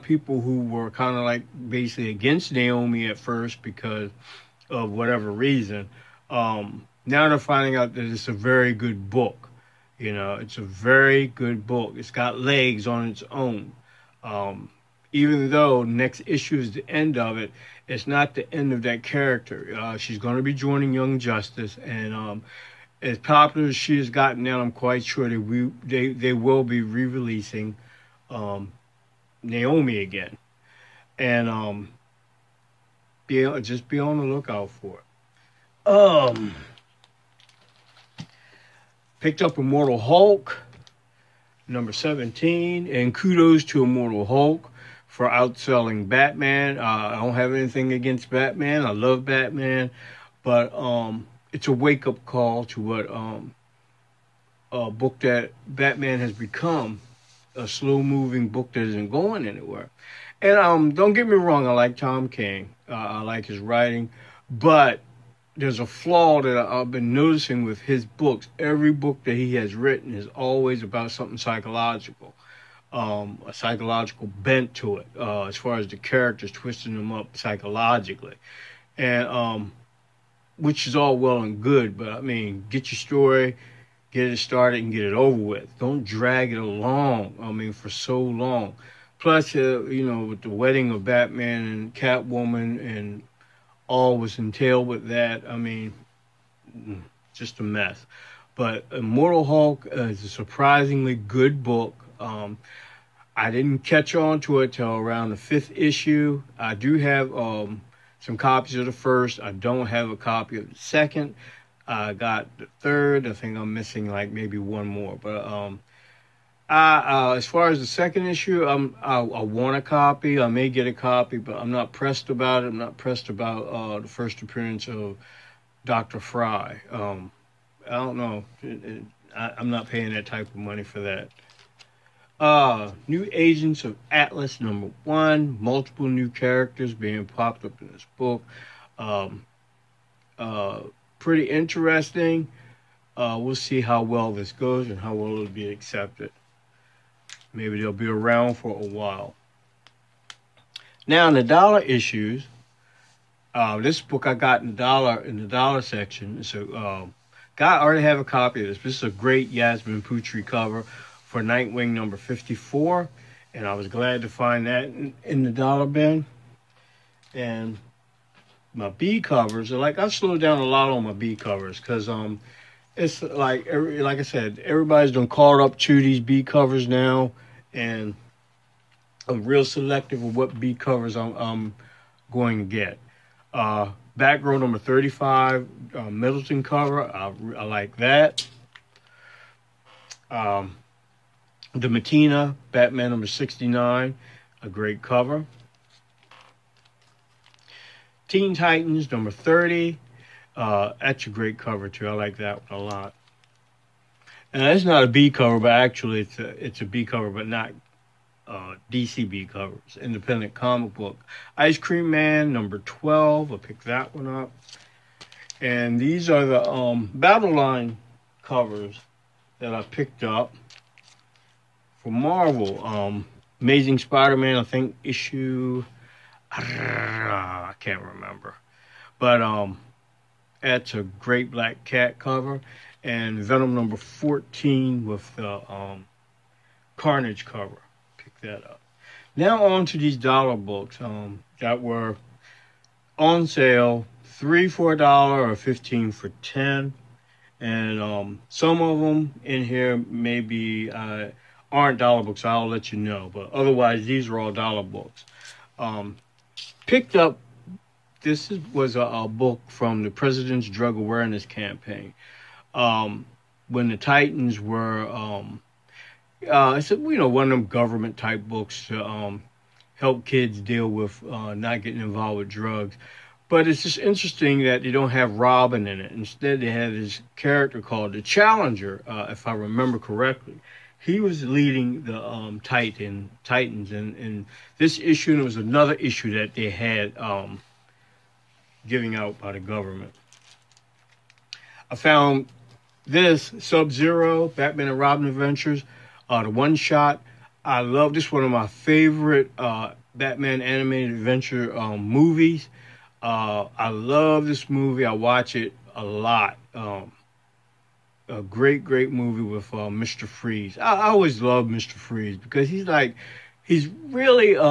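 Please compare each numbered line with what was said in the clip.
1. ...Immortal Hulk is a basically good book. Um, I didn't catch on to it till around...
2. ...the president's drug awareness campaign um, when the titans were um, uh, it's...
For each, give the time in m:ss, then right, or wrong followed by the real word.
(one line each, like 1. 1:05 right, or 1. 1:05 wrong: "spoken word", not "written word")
1. 1:38 wrong: "surprisingly", not "basically"
2. 4:20 right.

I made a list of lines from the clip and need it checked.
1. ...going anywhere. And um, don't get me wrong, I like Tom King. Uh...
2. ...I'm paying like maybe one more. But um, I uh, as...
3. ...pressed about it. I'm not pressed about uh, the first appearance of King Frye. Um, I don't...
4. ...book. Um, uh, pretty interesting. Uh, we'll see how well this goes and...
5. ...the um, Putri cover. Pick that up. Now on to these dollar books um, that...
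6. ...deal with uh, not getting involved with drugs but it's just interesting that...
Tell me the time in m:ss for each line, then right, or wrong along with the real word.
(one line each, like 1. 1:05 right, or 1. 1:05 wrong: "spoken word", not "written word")
1. 0:59 right
2. 1:53 wrong: "missing", not "paying"
3. 2:01 wrong: "Doctor", not "King"
4. 2:18 right
5. 3:55 wrong: "Carnage", not "Putri"
6. 4:30 right.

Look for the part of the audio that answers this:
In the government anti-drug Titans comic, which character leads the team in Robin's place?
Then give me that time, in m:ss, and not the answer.
4:38.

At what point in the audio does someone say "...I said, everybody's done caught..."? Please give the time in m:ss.
2:54.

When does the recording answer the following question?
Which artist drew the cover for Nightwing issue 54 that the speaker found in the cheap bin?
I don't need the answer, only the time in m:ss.
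2:39.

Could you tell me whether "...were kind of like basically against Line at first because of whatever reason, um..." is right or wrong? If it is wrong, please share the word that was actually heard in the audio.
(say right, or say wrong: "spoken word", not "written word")
wrong: "Naomi", not "Line".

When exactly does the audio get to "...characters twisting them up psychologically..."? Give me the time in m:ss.
1:15.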